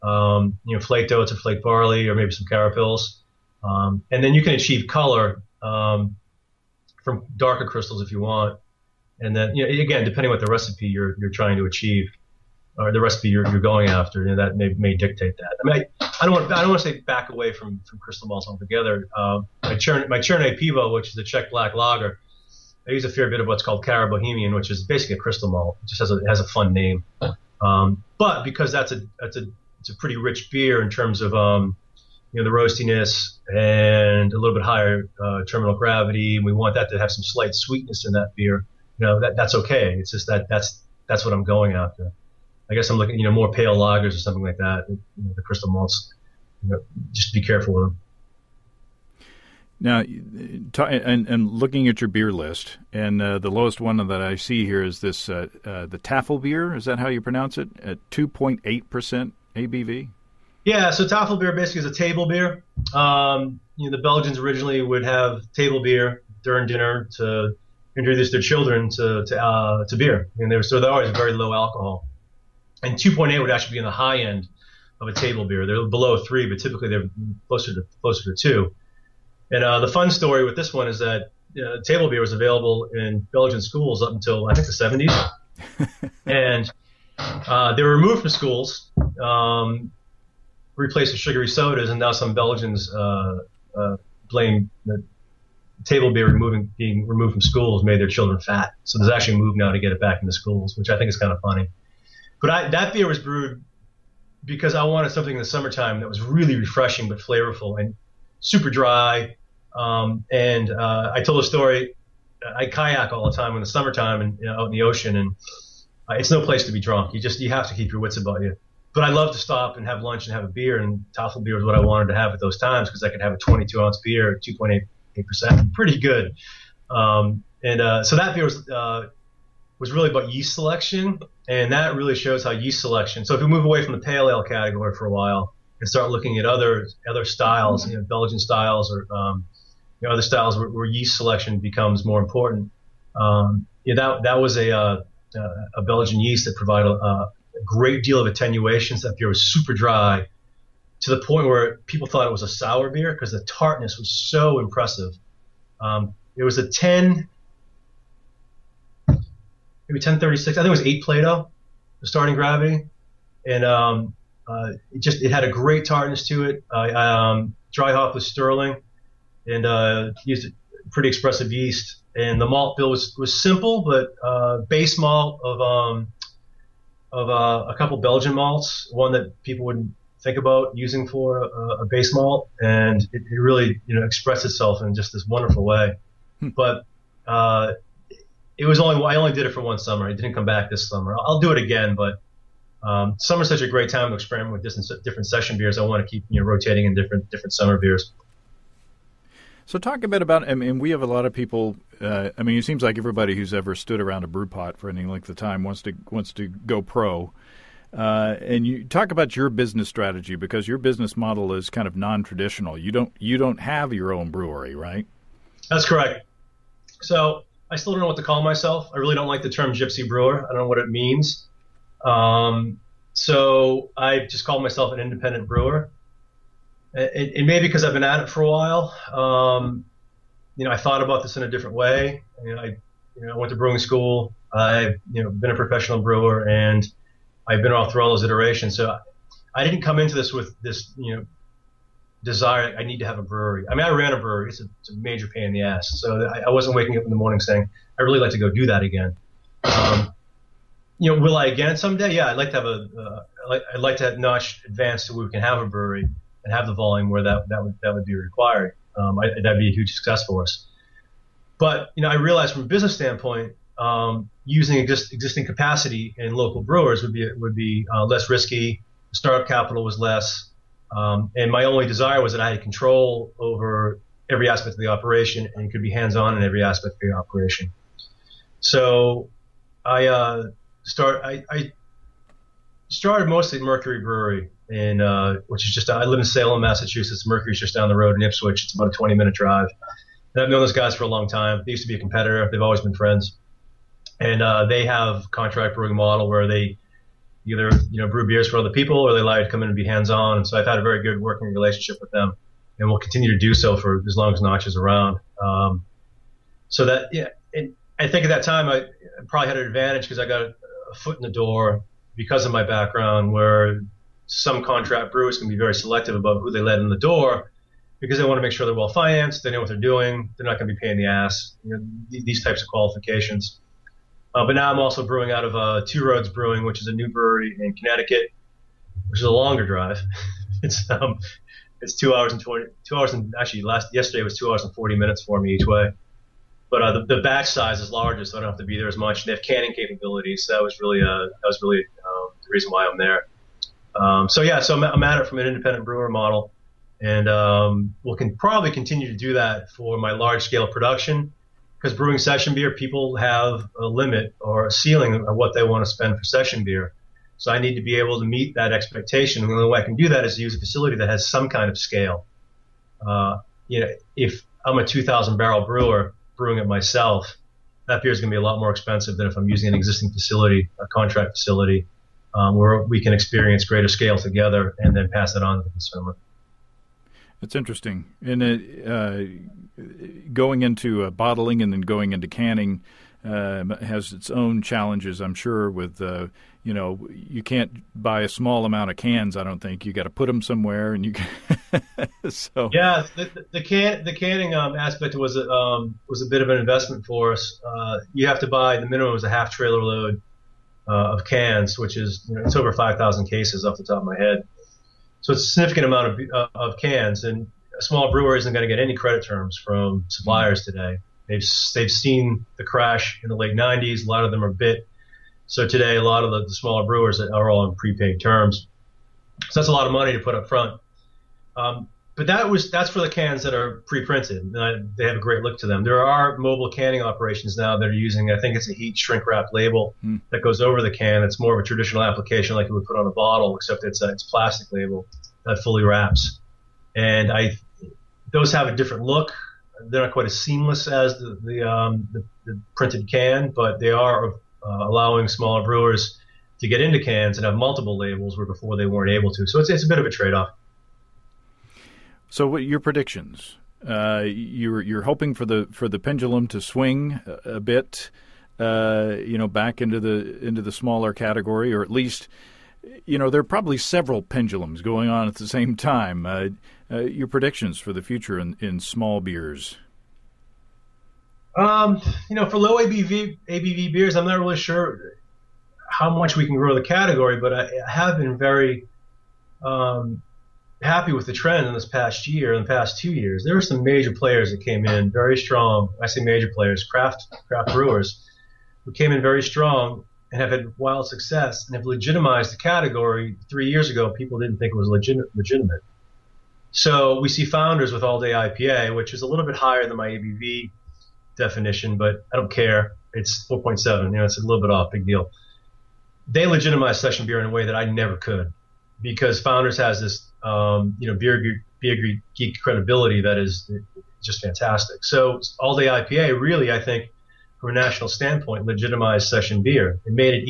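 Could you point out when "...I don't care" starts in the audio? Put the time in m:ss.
8:22.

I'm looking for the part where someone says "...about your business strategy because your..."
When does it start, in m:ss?
3:29.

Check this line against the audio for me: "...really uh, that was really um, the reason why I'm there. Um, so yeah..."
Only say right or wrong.
right.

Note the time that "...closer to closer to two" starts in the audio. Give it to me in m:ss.
1:17.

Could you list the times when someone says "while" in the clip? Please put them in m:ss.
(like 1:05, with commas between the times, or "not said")
2:15, 3:48.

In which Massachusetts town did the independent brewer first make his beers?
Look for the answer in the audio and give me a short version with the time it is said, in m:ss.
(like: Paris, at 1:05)
Ipswich, at 4:48.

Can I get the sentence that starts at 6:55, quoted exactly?
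So today, a lot of the, the smaller brewers are all on prepaid terms.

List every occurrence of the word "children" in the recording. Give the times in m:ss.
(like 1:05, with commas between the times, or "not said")
1:08, 1:38.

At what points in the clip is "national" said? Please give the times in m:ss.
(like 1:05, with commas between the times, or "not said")
8:37.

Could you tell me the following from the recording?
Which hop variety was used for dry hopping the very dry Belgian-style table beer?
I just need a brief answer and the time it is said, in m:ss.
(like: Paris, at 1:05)
Sterling, at 2:48.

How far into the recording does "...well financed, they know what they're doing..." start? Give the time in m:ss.
5:18.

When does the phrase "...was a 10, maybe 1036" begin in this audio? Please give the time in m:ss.
2:36.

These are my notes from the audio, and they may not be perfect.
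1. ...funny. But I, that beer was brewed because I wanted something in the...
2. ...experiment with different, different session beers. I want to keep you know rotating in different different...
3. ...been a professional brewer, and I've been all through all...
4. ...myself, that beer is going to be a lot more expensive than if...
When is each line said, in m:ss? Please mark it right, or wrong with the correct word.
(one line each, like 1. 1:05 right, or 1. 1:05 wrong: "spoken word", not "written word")
1. 1:41 right
2. 3:14 right
3. 3:55 right
4. 6:06 right.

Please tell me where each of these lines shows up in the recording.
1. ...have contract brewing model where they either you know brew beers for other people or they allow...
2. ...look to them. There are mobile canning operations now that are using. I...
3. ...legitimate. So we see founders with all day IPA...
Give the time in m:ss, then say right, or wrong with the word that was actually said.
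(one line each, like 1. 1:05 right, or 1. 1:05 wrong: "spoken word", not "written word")
1. 4:54 right
2. 7:05 right
3. 8:15 right.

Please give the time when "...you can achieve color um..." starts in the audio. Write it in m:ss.
0:04.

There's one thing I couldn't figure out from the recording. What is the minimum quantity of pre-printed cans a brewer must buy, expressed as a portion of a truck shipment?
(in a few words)
half trailer load.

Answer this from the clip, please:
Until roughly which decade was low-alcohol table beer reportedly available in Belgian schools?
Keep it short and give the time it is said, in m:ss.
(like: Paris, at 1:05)
the 70s, at 1:24.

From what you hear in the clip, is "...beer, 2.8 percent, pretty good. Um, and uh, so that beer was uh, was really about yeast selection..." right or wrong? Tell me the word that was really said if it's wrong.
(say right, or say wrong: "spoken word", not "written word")
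right.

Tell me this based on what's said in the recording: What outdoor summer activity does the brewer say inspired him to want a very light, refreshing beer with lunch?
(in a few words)
kayak.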